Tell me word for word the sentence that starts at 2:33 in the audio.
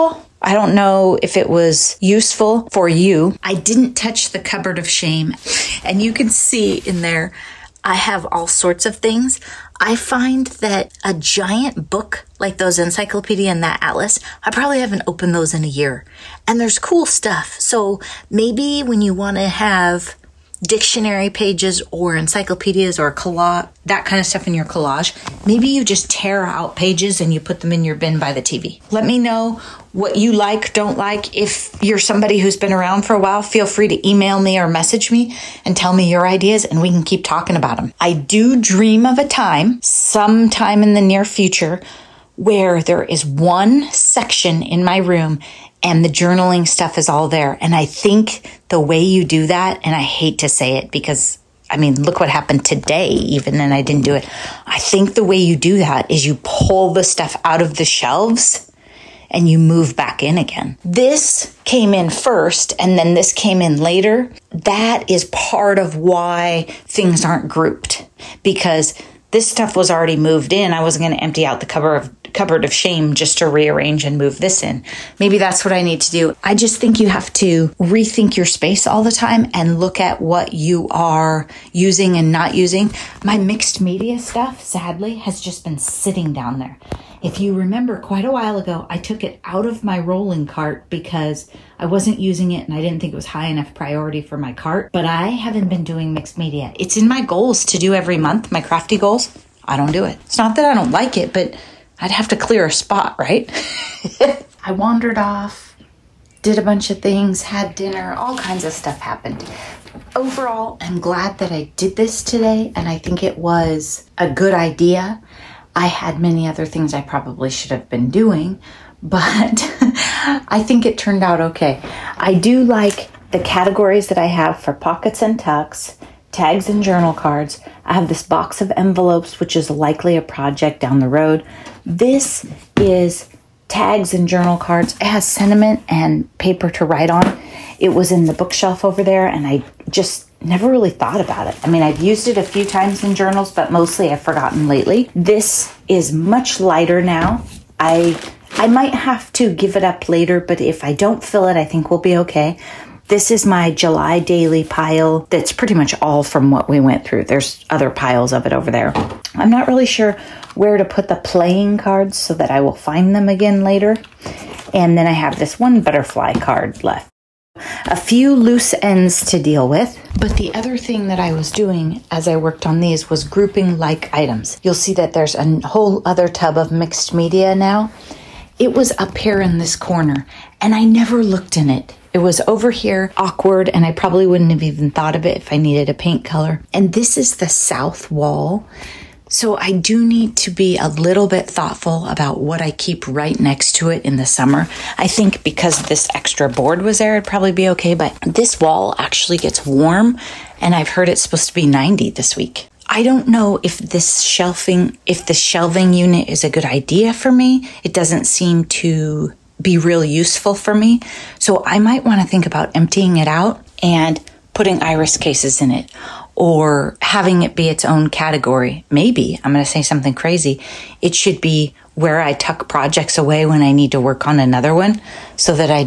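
This is my July daily pile that's pretty much all from what we went through.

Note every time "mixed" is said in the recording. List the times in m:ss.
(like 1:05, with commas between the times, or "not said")
1:23, 1:36, 2:56.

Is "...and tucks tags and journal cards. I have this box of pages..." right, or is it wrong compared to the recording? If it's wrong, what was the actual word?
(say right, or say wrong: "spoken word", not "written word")
wrong: "envelopes", not "pages".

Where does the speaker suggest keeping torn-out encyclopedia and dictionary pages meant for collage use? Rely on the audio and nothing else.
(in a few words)
bin by the TV.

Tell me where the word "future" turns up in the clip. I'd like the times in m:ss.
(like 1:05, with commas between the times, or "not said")
0:41.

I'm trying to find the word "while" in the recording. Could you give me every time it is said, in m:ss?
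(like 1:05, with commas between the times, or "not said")
0:33, 1:28.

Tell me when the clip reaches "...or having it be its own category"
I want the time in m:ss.
3:36.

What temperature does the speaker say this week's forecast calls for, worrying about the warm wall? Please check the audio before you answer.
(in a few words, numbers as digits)
90.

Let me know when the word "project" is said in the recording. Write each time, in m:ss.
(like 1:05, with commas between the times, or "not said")
2:10, 3:42.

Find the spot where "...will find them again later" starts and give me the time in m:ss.
2:42.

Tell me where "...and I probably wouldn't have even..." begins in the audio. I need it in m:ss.
3:03.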